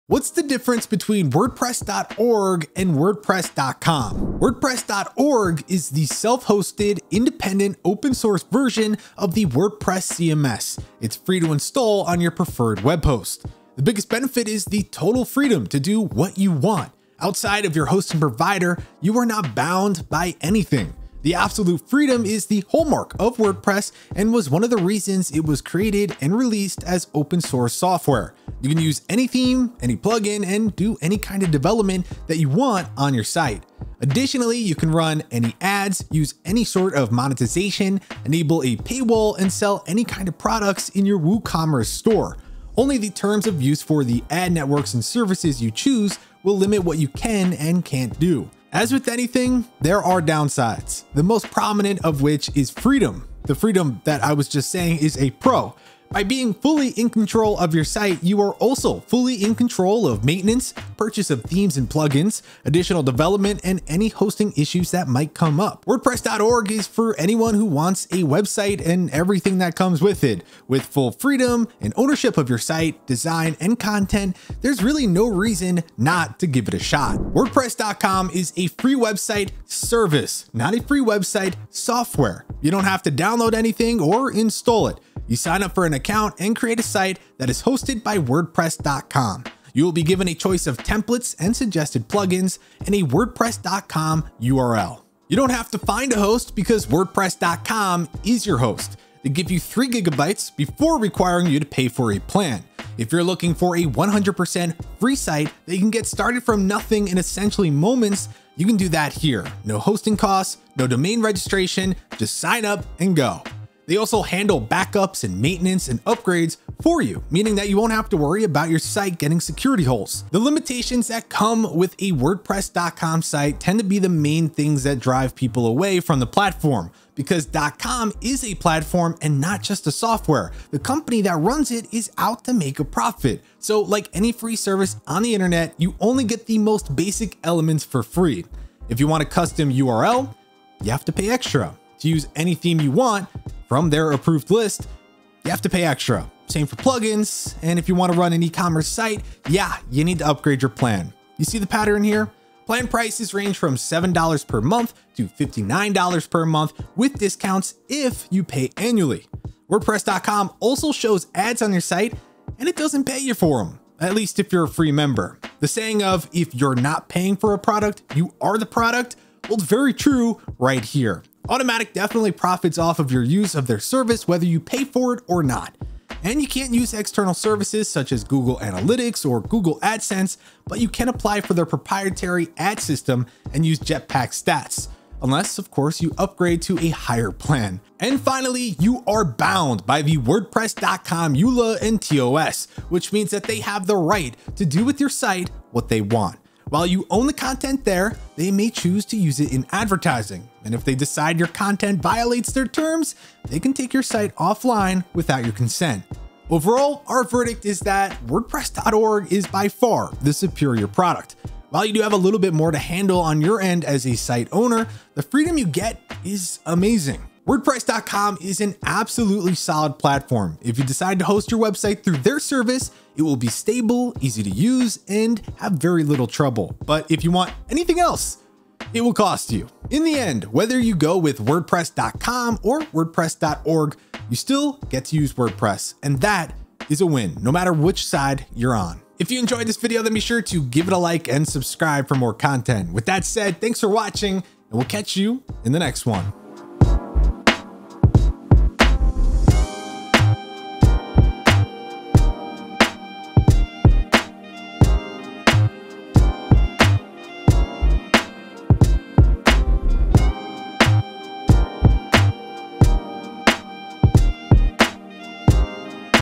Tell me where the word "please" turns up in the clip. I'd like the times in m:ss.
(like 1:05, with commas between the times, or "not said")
not said.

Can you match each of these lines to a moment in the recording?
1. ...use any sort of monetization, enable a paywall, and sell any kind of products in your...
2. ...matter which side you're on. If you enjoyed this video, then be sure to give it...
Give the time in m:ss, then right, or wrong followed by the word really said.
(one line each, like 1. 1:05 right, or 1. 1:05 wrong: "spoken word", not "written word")
1. 0:36 right
2. 3:57 right.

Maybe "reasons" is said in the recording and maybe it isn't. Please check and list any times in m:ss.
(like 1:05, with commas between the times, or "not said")
0:24, 1:15.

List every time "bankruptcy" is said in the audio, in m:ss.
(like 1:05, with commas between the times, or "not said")
not said.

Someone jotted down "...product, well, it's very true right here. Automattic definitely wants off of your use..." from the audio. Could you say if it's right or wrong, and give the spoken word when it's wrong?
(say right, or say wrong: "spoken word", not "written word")
wrong: "profits", not "wants".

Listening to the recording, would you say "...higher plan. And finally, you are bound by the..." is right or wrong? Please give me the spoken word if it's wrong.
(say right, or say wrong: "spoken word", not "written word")
right.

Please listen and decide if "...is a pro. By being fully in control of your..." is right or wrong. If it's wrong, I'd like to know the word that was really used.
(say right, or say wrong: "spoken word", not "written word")
right.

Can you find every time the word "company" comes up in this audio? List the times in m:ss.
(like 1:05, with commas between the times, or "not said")
2:10.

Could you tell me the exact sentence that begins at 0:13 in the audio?
The biggest benefit is the total freedom to do what you want.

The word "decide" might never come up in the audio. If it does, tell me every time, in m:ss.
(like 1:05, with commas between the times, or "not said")
3:20, 3:40.